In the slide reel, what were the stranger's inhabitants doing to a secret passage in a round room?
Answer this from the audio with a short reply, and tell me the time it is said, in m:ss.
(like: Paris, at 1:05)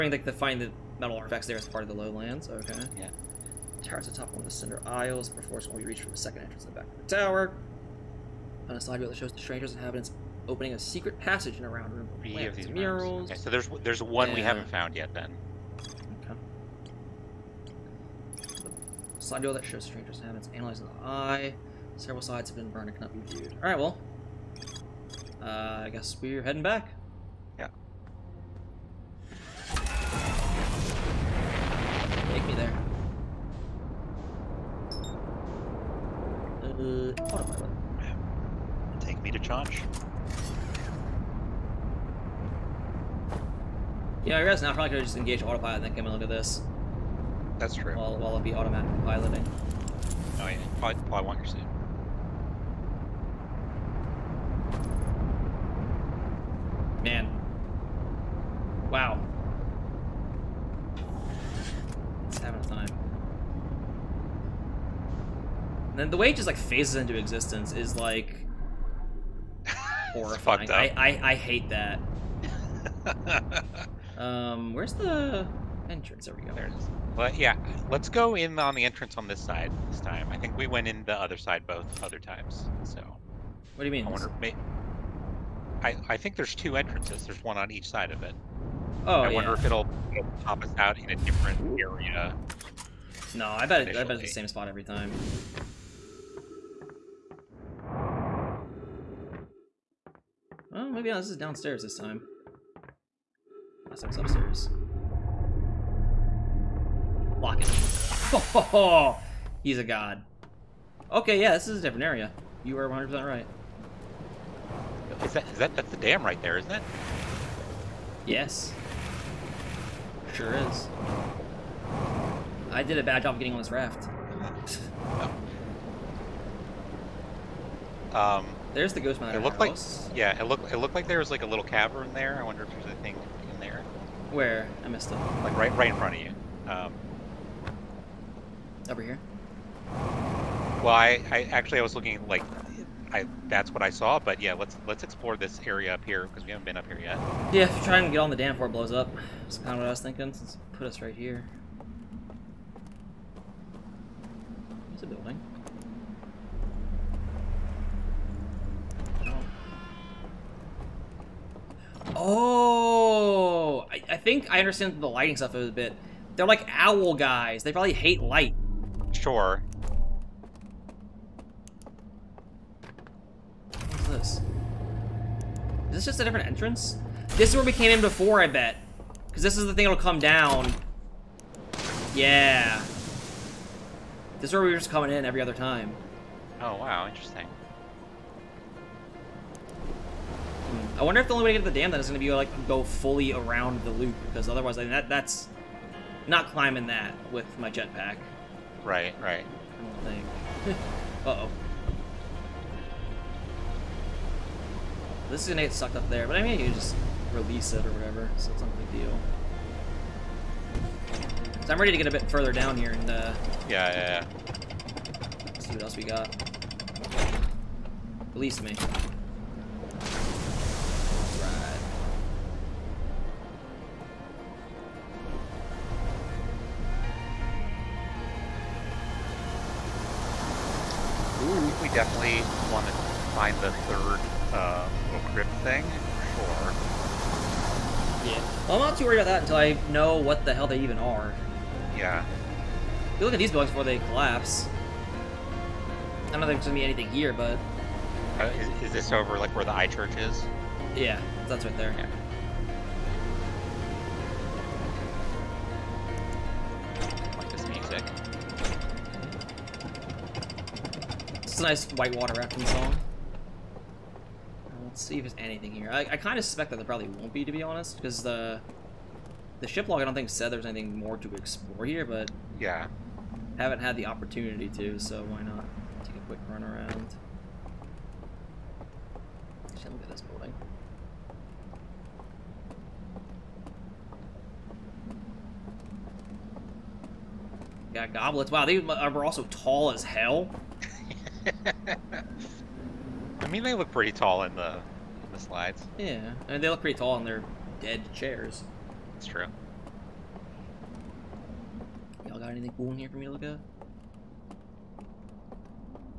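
Opening, at 0:10.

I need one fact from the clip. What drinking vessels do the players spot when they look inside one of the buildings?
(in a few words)
Goblets.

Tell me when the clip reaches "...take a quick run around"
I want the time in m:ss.
4:36.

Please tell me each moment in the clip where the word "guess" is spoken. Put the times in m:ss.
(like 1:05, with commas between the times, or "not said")
0:25, 0:44.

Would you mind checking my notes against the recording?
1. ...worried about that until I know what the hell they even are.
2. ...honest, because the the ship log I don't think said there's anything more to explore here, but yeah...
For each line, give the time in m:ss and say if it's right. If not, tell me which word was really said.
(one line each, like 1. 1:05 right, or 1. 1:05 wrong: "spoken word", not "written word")
1. 3:59 right
2. 4:27 right.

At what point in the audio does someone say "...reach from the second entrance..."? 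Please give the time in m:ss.
0:05.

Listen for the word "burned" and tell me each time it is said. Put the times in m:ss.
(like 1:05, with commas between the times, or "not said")
0:22.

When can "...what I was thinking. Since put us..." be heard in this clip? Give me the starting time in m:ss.
2:29.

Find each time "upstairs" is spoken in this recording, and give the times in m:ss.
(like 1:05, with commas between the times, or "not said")
1:44.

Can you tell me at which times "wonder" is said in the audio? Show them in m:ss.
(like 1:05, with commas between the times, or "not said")
1:24, 1:29, 2:12, 3:11.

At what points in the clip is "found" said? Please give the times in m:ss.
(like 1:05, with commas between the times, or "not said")
0:14.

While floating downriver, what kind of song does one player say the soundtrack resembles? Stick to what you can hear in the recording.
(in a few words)
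Whitewater rafting song.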